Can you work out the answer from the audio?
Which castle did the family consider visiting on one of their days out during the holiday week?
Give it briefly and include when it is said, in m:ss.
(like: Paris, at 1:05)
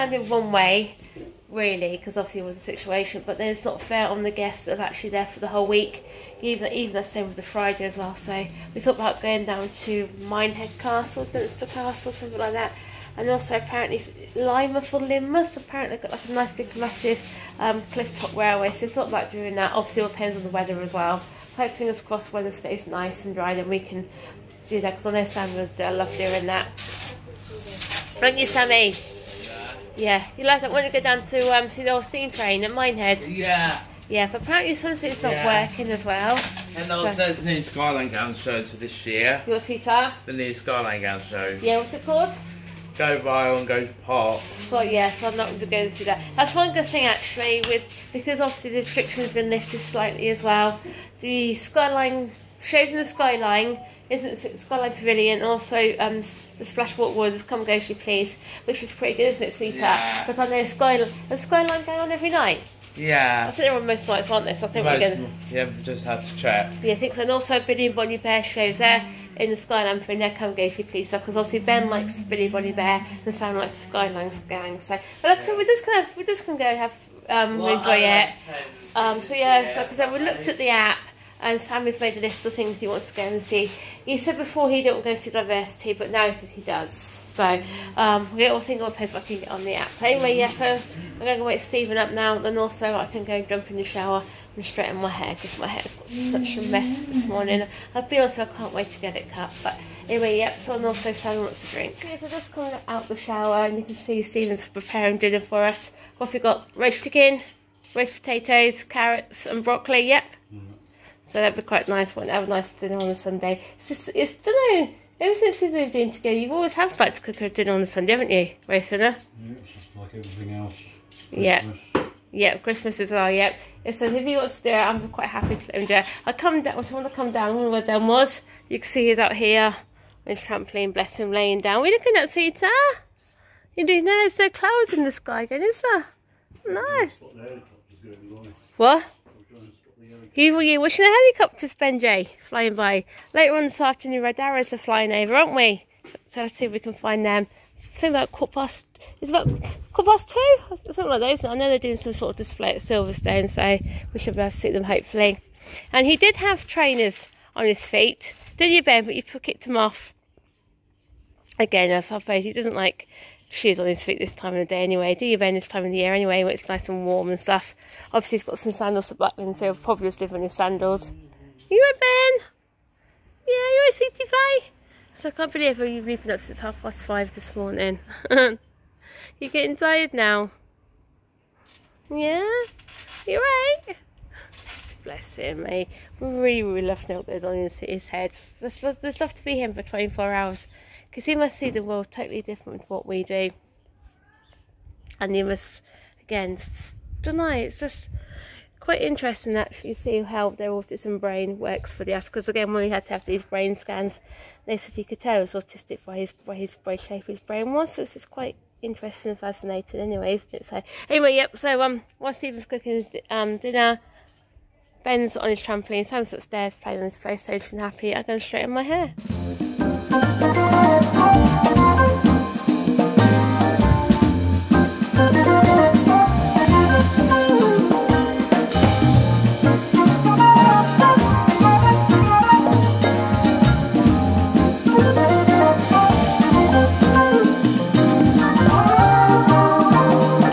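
Dunster Castle, at 0:11.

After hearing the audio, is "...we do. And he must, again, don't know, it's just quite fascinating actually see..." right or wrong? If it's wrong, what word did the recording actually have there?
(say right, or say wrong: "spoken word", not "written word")
wrong: "interesting", not "fascinating".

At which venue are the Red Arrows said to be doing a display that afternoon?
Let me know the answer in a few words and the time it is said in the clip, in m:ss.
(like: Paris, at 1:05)
Silverstone, at 2:32.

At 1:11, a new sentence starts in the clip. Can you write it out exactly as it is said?
likes Billy Bonnie Bear and Sam likes the Skyline gang.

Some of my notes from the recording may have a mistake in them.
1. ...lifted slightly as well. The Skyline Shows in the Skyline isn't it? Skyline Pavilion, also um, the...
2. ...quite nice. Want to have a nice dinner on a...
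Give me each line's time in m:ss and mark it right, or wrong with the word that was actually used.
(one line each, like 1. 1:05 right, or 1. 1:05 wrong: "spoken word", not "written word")
1. 0:49 right
2. 1:51 right.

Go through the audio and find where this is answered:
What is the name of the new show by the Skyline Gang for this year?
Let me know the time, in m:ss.
0:42.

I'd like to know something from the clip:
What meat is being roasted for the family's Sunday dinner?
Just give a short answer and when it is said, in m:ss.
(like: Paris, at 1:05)
Chicken, at 1:46.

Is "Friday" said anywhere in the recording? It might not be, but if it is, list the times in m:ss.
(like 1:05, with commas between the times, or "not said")
0:07.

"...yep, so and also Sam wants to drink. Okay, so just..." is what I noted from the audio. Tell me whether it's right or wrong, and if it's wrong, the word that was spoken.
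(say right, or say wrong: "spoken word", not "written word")
right.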